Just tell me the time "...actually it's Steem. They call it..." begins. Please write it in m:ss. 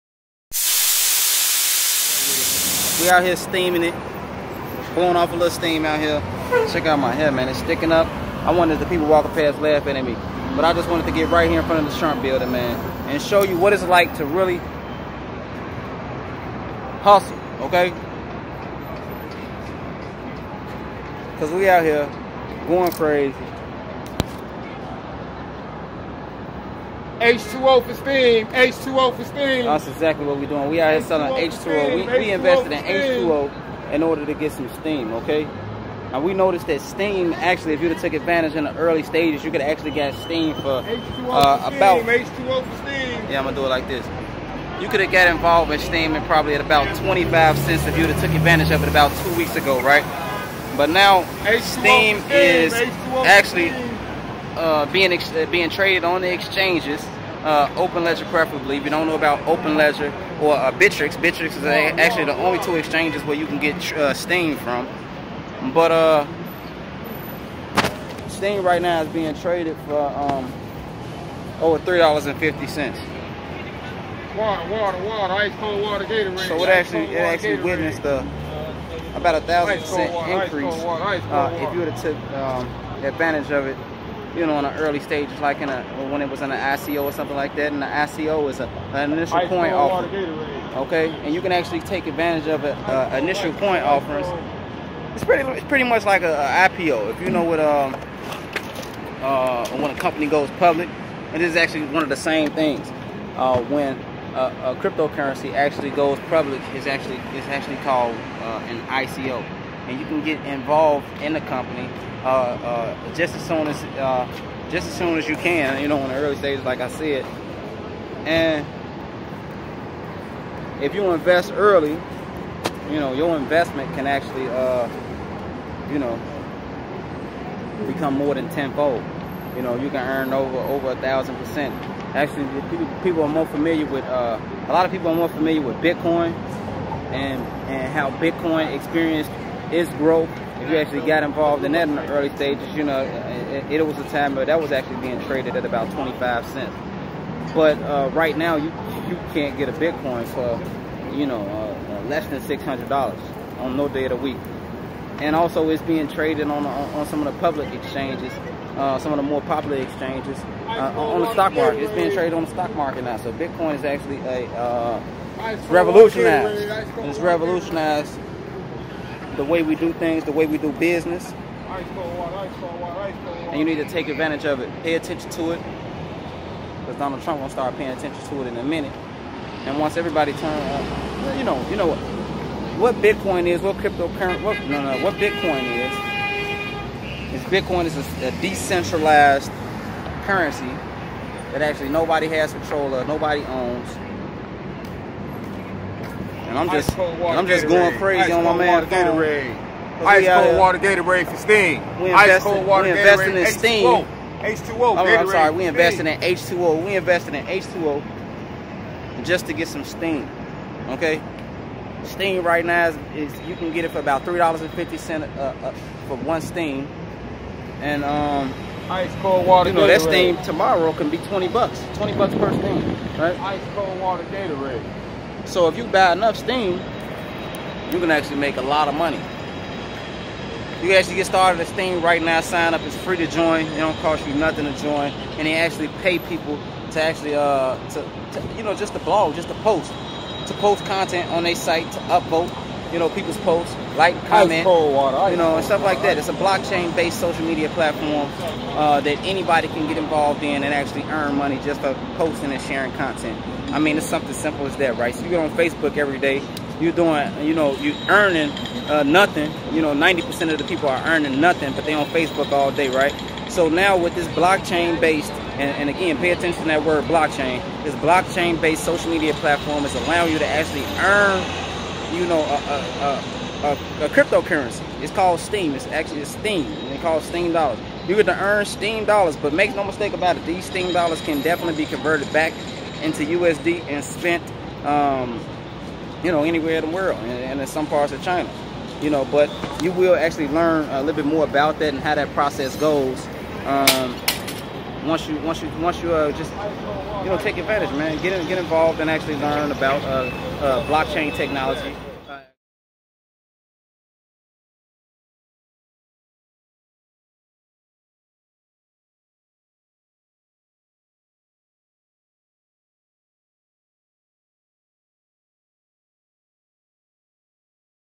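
4:35.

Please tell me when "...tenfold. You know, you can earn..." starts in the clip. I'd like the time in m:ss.
2:08.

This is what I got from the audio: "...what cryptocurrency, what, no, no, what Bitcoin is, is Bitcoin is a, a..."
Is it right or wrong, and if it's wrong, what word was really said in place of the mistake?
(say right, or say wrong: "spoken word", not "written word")
right.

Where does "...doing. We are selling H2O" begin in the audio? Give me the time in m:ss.
0:30.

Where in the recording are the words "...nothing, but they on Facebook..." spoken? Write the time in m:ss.
4:21.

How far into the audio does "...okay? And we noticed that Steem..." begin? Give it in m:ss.
0:35.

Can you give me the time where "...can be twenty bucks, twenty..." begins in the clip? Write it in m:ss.
3:40.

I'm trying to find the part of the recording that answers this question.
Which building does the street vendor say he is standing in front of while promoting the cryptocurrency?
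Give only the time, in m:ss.
0:11.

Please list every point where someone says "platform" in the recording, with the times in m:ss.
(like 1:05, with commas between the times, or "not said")
4:07, 4:29.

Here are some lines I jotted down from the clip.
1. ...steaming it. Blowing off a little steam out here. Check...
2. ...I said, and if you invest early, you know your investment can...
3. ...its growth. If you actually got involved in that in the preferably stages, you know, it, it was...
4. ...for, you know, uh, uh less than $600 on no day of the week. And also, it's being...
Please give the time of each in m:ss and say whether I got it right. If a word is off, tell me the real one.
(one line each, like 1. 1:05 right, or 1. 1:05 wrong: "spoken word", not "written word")
1. 0:03 right
2. 1:56 right
3. 2:19 wrong: "early", not "preferably"
4. 2:30 right.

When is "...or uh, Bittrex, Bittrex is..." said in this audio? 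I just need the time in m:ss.
1:00.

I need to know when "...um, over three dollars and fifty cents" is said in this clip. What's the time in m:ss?
1:10.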